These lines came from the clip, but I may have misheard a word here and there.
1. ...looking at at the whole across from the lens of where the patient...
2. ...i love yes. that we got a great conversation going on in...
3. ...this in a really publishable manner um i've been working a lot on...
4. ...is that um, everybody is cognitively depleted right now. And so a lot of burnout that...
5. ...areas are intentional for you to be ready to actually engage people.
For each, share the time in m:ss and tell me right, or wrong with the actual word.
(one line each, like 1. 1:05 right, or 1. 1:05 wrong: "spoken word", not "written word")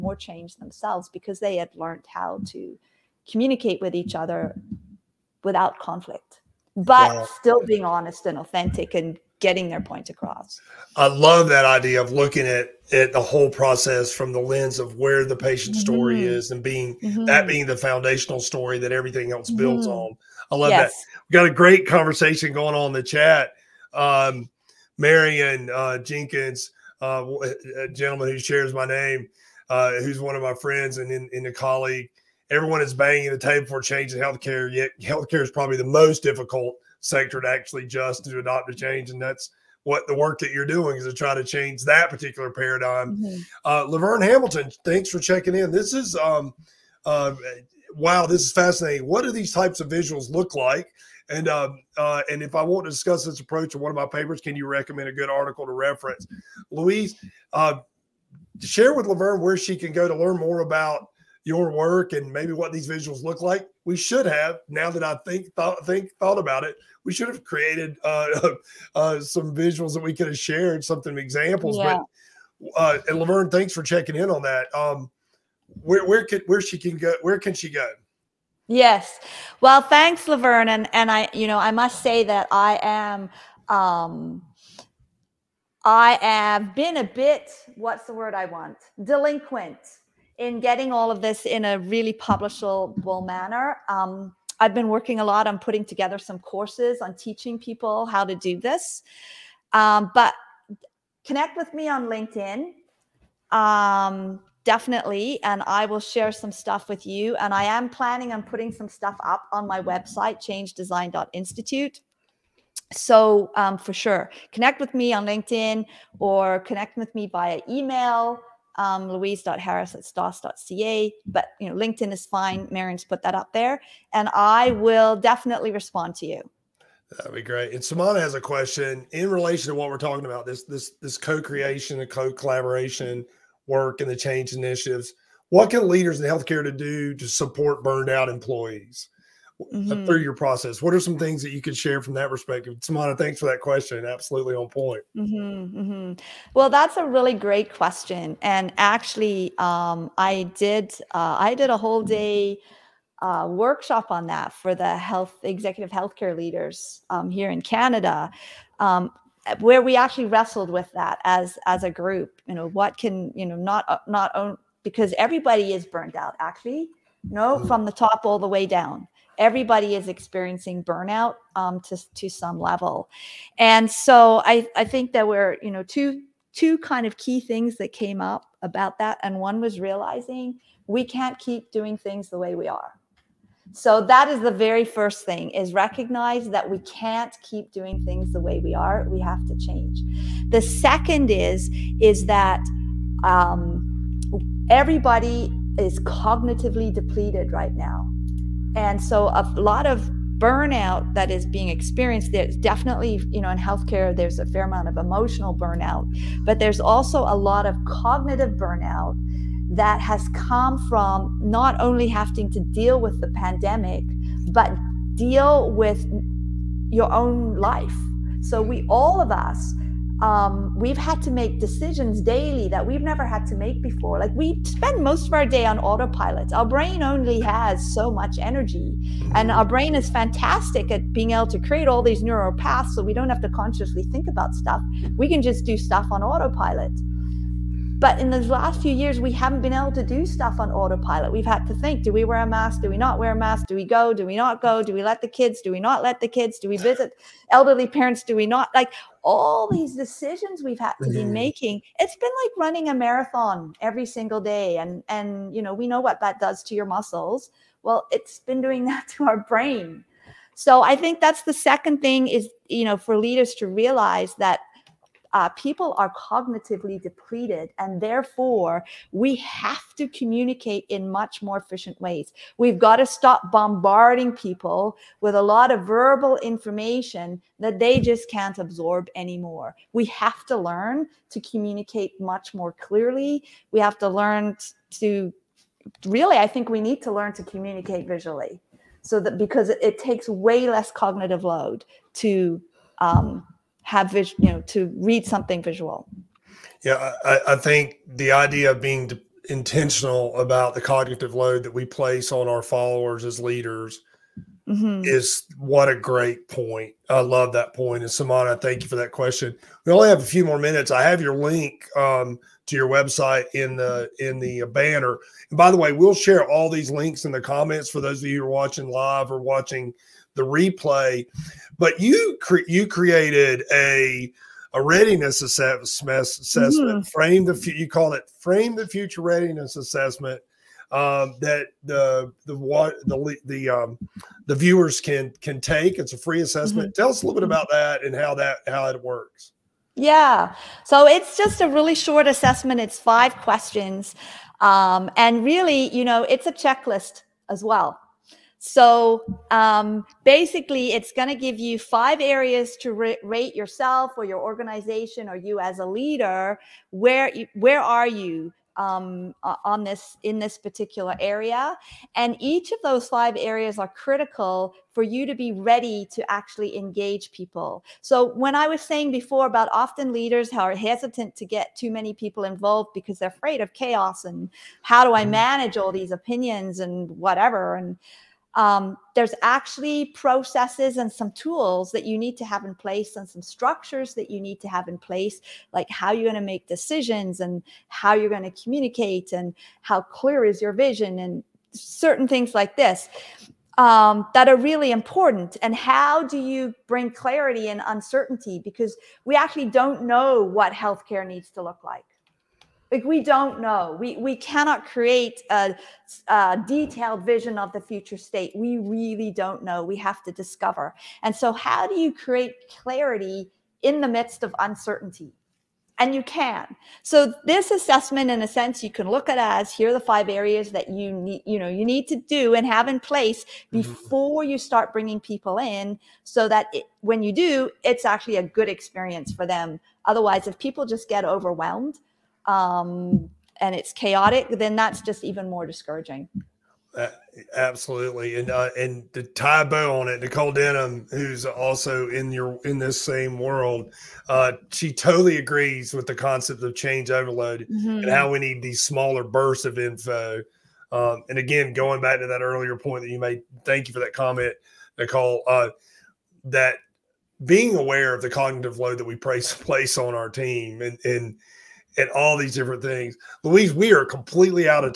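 1. 0:12 wrong: "process", not "across"
2. 0:20 right
3. 1:31 right
4. 3:11 right
5. 6:03 wrong: "critical", not "intentional".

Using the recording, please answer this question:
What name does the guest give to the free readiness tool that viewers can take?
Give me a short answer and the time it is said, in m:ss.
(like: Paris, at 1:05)
Frame the Future Readiness Assessment, at 5:28.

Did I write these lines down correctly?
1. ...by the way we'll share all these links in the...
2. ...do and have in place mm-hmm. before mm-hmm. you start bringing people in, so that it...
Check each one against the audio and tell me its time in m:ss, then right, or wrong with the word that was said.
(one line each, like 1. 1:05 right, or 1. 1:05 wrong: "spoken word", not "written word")
1. 5:15 right
2. 7:02 right.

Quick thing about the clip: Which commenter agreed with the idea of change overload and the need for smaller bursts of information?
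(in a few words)
Nicole Denham.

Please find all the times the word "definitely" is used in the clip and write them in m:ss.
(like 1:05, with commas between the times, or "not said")
1:44, 2:05, 3:22.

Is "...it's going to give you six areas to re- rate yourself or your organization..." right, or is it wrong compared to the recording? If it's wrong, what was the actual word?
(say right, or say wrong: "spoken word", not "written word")
wrong: "five", not "six".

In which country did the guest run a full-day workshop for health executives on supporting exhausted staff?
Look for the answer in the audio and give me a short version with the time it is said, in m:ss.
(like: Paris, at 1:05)
Canada, at 2:37.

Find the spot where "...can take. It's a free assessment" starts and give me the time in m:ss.
5:35.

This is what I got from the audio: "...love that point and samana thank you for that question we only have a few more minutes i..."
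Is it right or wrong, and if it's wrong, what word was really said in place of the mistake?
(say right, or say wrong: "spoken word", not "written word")
right.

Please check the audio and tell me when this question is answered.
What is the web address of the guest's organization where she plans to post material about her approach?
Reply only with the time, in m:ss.
1:50.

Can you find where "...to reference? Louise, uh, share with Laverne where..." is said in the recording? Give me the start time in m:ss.
0:55.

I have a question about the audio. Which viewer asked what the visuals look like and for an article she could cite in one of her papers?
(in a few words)
Laverne Hamilton.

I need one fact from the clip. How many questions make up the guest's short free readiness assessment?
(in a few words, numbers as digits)
5.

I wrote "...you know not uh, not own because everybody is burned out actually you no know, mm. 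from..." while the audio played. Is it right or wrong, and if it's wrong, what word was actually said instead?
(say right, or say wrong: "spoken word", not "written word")
right.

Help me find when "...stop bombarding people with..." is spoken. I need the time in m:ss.
4:33.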